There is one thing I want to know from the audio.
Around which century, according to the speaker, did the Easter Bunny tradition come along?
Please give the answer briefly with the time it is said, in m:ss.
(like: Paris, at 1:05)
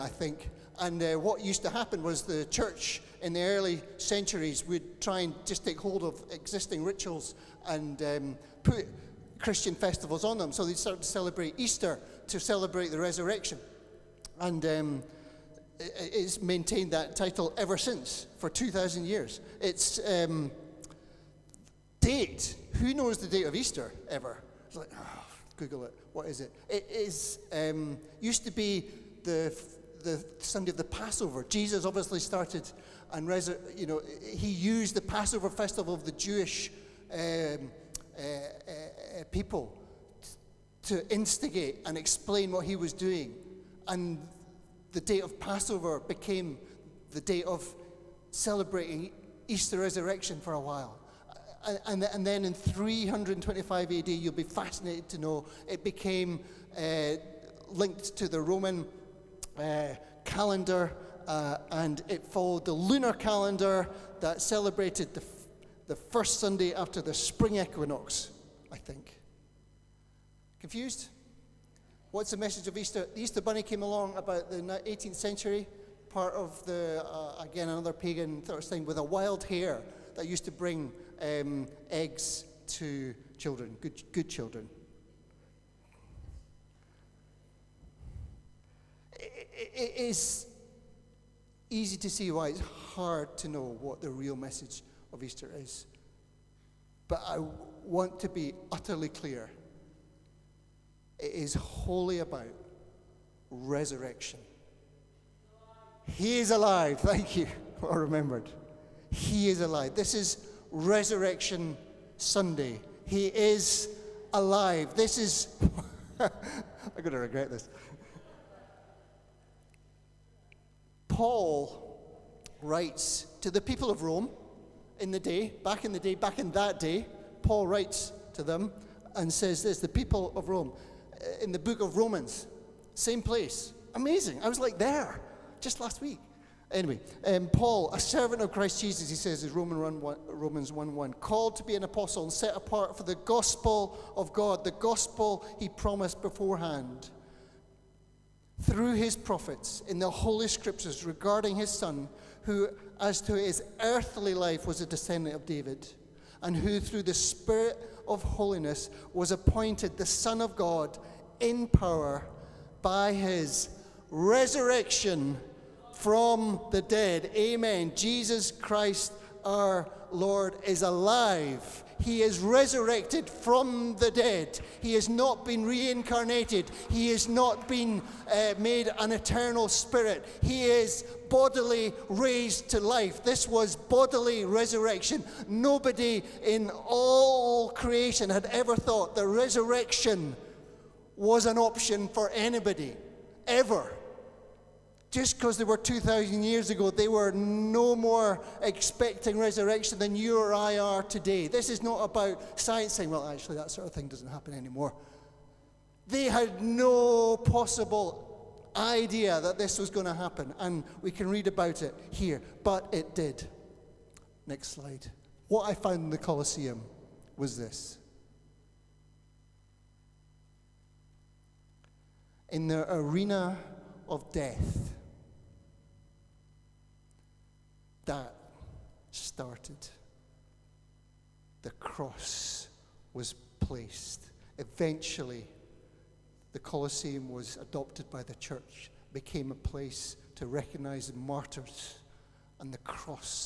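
18th century, at 1:14.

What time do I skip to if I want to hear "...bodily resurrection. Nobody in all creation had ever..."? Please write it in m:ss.
3:03.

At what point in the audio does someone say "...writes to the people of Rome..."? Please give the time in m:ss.
2:02.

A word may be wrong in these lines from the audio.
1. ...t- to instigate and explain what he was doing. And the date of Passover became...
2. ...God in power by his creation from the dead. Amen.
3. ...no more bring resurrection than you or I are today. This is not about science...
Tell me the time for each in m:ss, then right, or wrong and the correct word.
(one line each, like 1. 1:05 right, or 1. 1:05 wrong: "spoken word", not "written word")
1. 0:40 right
2. 2:40 wrong: "resurrection", not "creation"
3. 3:17 wrong: "expecting", not "bring".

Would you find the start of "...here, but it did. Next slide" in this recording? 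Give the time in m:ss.
3:32.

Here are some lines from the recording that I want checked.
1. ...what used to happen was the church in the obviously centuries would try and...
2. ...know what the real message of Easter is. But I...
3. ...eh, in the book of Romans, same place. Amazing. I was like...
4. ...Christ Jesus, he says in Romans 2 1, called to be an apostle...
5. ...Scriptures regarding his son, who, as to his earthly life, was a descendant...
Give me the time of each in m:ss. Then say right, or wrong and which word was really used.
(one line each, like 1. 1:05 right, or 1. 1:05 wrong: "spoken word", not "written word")
1. 0:01 wrong: "early", not "obviously"
2. 1:33 right
3. 2:11 right
4. 2:18 wrong: "1", not "2"
5. 2:30 right.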